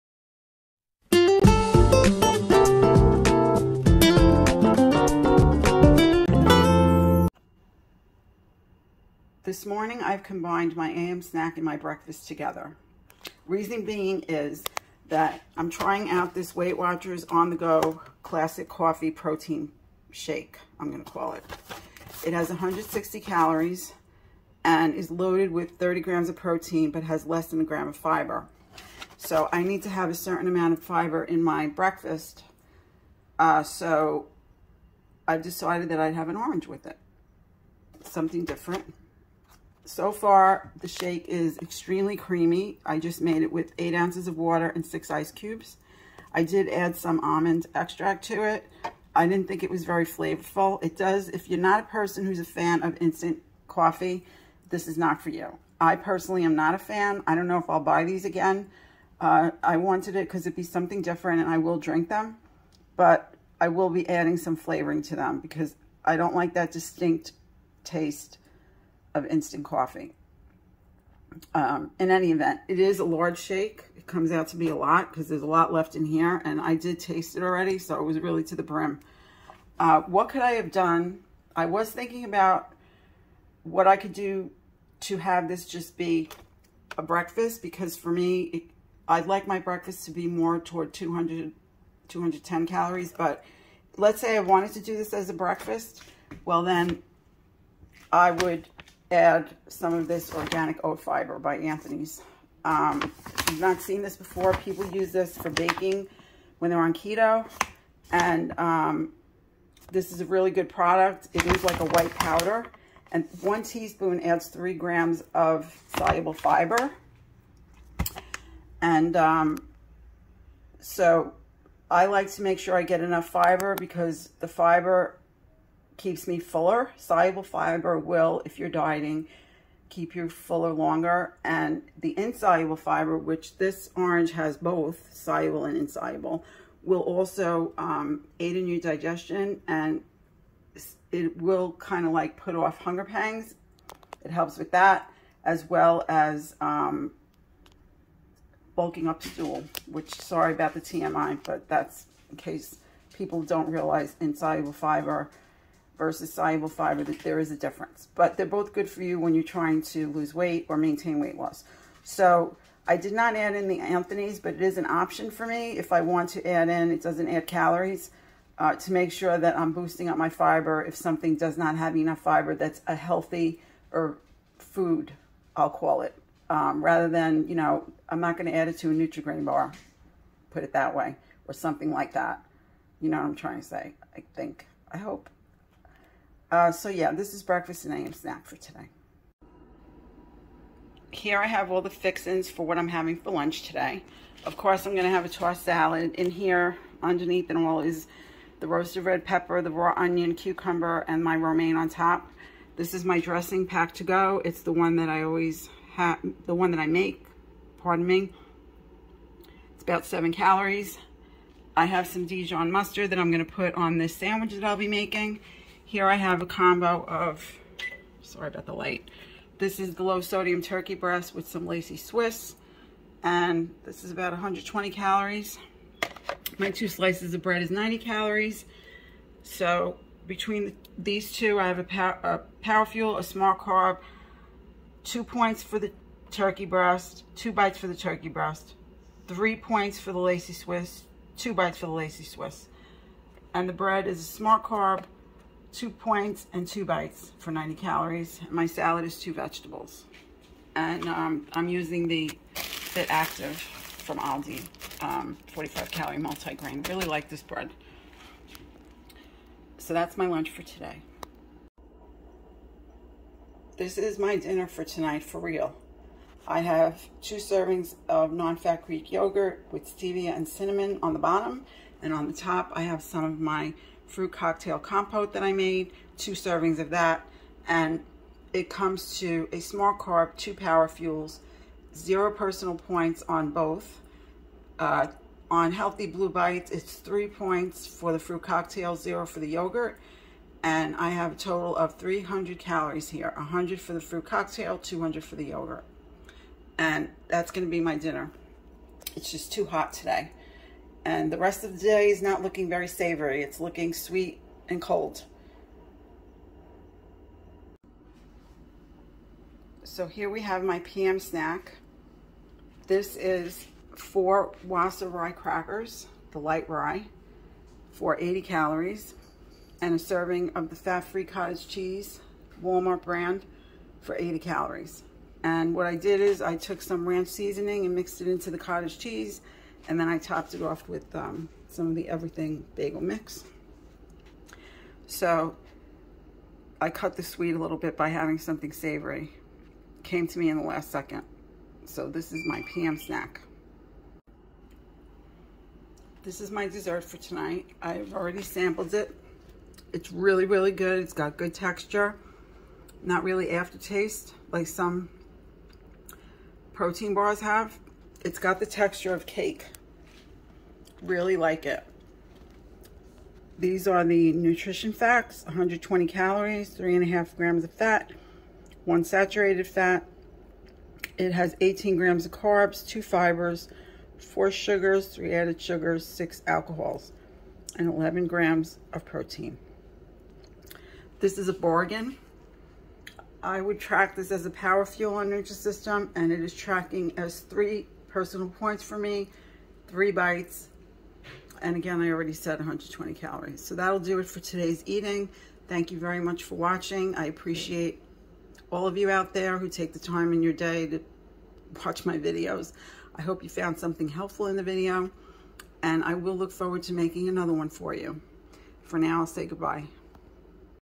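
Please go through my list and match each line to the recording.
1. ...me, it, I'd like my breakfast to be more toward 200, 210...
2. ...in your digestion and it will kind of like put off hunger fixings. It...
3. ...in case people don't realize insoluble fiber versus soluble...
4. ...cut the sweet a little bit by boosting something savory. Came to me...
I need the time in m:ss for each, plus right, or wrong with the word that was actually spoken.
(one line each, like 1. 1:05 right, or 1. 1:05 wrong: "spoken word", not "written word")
1. 1:28 right
2. 2:18 wrong: "pangs", not "fixings"
3. 2:32 right
4. 5:36 wrong: "having", not "boosting".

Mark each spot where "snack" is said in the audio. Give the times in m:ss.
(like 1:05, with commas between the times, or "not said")
0:11, 3:08, 5:11, 5:42.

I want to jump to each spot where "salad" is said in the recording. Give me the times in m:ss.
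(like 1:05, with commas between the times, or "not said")
3:15, 4:08.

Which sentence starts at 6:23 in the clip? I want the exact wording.
I would track this as a power fuel energy system, and it is tracking as three personal points for me, three bites.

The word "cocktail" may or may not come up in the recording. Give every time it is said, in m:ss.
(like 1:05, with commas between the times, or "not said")
4:34, 4:48, 4:54.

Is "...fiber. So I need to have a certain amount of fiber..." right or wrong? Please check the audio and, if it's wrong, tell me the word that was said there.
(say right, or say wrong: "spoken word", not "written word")
right.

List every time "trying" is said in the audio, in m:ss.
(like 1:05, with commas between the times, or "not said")
0:15, 2:39, 3:03.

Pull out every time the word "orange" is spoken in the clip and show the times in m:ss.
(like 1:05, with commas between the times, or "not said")
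0:36, 2:13.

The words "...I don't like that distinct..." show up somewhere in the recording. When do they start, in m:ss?
1:06.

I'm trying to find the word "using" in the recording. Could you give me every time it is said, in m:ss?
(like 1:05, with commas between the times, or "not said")
4:11.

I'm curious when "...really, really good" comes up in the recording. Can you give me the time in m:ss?
5:50.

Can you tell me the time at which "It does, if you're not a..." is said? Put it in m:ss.
0:50.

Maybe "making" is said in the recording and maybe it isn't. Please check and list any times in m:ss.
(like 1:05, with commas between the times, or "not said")
3:34, 6:46.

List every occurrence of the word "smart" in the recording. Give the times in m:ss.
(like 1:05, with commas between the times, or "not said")
3:53, 4:04.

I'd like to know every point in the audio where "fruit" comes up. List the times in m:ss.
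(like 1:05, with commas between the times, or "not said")
4:34, 4:48, 4:54.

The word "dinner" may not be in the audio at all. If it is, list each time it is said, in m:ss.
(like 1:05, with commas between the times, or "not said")
4:24, 4:57.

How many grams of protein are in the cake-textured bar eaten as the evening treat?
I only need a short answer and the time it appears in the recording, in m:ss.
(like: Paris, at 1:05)
11 grams, at 6:17.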